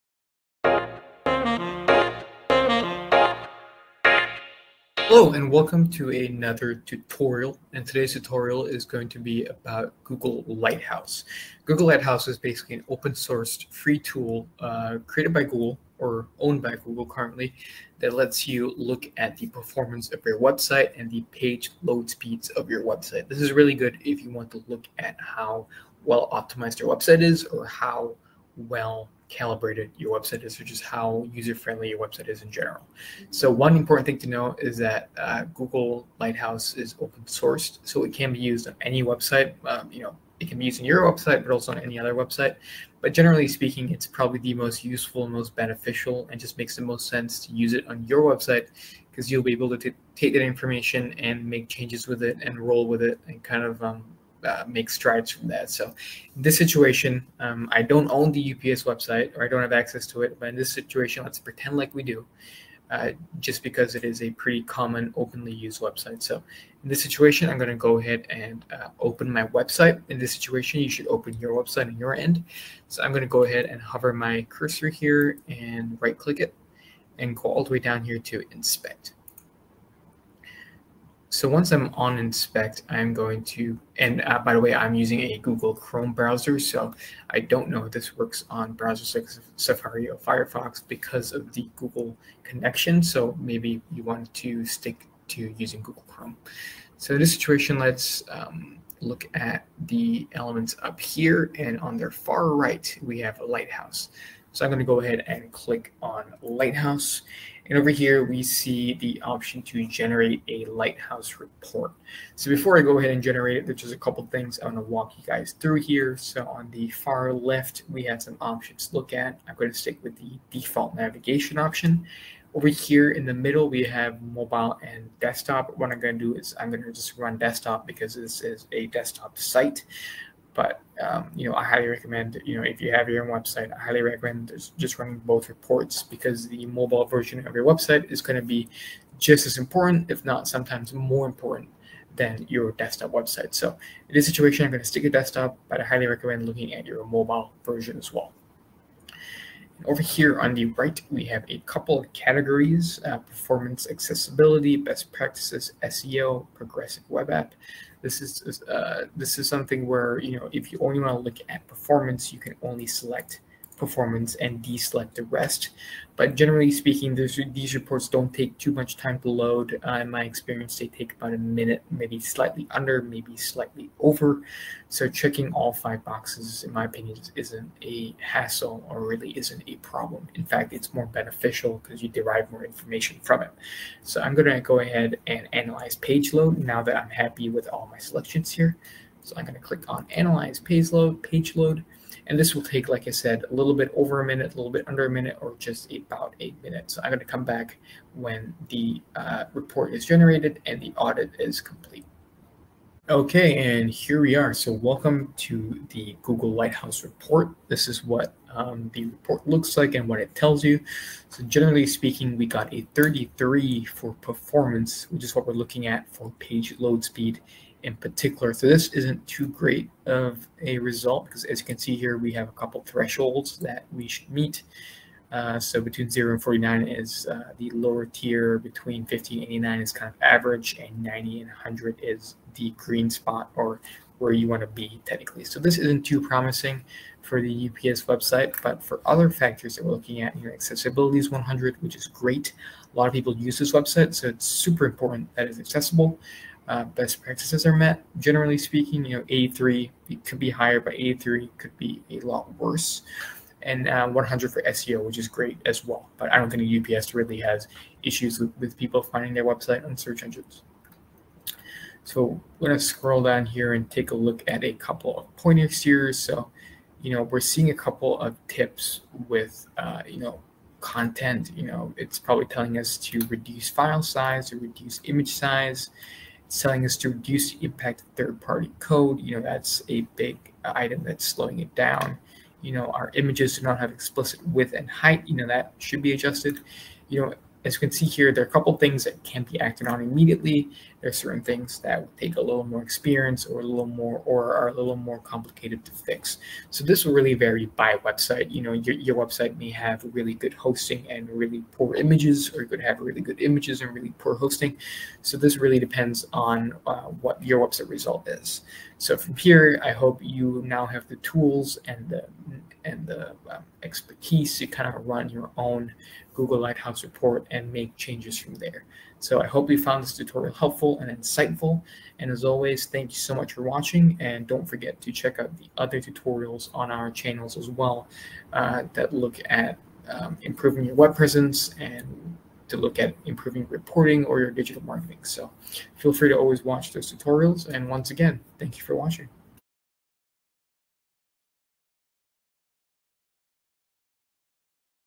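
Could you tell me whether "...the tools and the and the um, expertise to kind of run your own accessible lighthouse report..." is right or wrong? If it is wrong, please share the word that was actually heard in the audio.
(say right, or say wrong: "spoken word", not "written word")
wrong: "google", not "accessible".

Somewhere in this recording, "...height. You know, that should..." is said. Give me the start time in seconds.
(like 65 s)
284 s.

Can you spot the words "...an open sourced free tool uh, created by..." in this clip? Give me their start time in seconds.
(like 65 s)
12 s.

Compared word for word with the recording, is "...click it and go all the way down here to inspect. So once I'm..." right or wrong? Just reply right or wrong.
right.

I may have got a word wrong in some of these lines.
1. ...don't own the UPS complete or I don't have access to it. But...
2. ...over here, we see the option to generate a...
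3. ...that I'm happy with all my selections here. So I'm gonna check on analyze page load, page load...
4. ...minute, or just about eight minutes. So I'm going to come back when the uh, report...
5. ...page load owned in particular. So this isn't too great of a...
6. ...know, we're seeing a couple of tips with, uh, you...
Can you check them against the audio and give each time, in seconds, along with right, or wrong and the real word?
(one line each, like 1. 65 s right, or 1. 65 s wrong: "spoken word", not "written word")
1. 57 s wrong: "website", not "complete"
2. 107 s right
3. 186 s wrong: "click", not "check"
4. 195 s right
5. 216 s wrong: "speed", not "owned"
6. 267 s right.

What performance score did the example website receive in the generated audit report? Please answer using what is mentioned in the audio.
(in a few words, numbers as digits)
33.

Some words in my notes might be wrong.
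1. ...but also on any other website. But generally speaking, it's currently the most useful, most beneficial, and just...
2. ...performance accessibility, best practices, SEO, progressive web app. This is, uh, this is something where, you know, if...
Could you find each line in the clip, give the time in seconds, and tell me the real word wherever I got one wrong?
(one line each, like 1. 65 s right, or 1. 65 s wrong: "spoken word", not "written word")
1. 41 s wrong: "probably", not "currently"
2. 153 s right.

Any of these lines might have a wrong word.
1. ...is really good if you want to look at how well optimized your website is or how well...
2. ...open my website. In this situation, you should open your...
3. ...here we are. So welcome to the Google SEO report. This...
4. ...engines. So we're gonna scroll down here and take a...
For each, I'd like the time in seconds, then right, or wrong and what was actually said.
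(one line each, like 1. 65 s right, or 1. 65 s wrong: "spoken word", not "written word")
1. 23 s right
2. 68 s right
3. 203 s wrong: "Lighthouse", not "SEO"
4. 260 s right.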